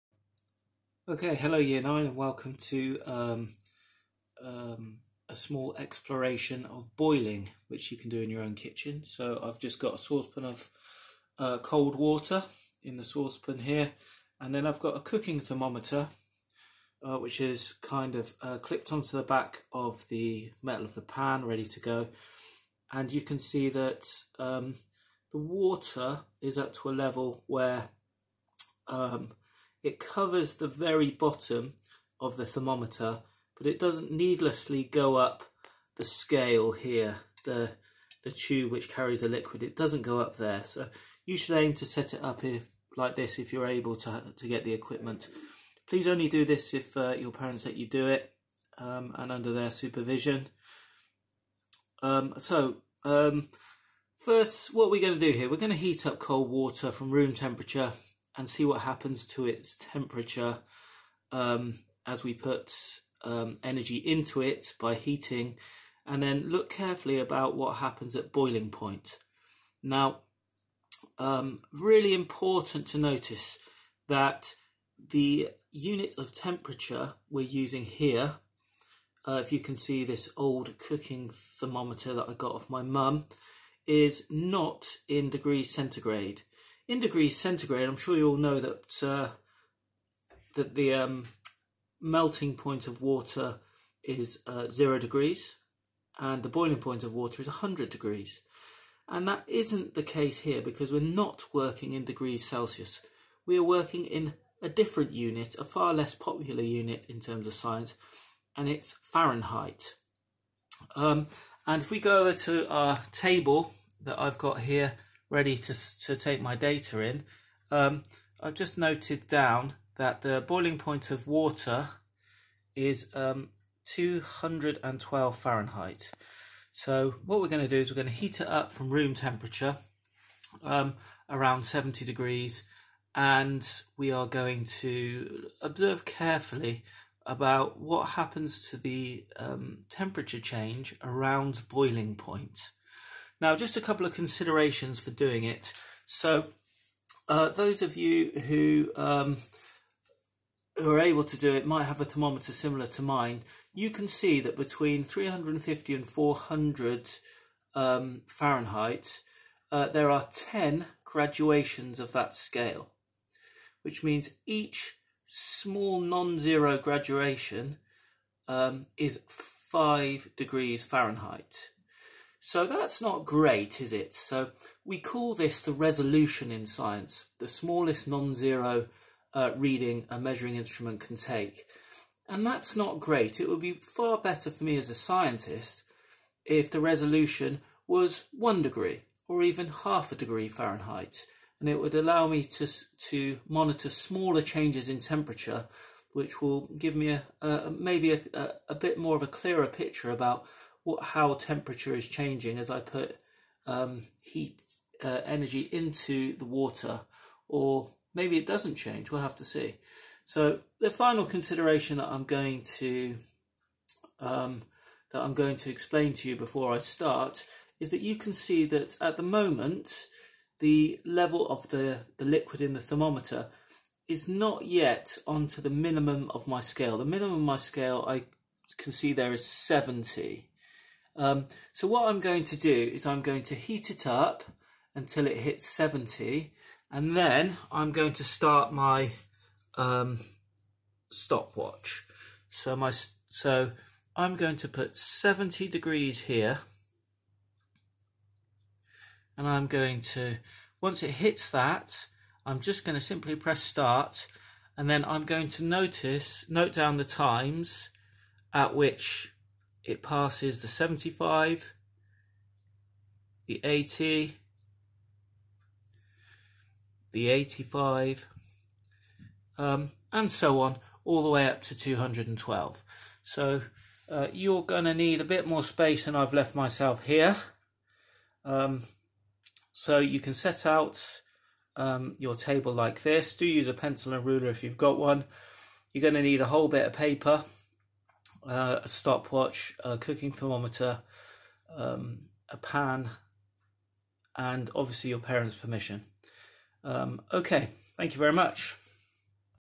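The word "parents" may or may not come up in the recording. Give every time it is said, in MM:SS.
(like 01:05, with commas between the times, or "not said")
00:47, 04:55.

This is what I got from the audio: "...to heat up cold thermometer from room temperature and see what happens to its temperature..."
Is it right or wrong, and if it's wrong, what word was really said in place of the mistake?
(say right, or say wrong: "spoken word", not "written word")
wrong: "water", not "thermometer".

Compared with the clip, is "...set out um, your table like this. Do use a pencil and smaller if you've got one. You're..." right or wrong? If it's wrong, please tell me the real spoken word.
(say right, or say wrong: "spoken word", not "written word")
wrong: "ruler", not "smaller".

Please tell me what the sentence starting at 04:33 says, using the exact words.
So uh, you're going to need a bit more space than I've left myself here.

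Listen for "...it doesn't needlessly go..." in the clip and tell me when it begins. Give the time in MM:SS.
00:33.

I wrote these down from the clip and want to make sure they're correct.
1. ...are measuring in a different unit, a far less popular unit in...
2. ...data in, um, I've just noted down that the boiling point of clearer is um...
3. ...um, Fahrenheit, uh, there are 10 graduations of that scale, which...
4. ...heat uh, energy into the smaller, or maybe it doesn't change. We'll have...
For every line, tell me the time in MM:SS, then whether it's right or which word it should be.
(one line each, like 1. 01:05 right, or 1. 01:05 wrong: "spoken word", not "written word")
1. 01:43 wrong: "working", not "measuring"
2. 01:56 wrong: "water", not "clearer"
3. 02:37 right
4. 03:24 wrong: "water", not "smaller".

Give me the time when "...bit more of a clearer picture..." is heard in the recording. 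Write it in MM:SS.
03:18.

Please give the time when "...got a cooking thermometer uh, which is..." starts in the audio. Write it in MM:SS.
00:14.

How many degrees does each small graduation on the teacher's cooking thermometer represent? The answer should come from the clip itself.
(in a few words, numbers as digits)
5 degrees Fahrenheit.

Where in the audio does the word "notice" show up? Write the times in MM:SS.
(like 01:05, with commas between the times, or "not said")
01:12, 04:15.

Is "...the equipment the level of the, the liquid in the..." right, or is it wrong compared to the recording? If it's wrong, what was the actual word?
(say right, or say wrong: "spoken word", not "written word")
wrong: "moment", not "equipment".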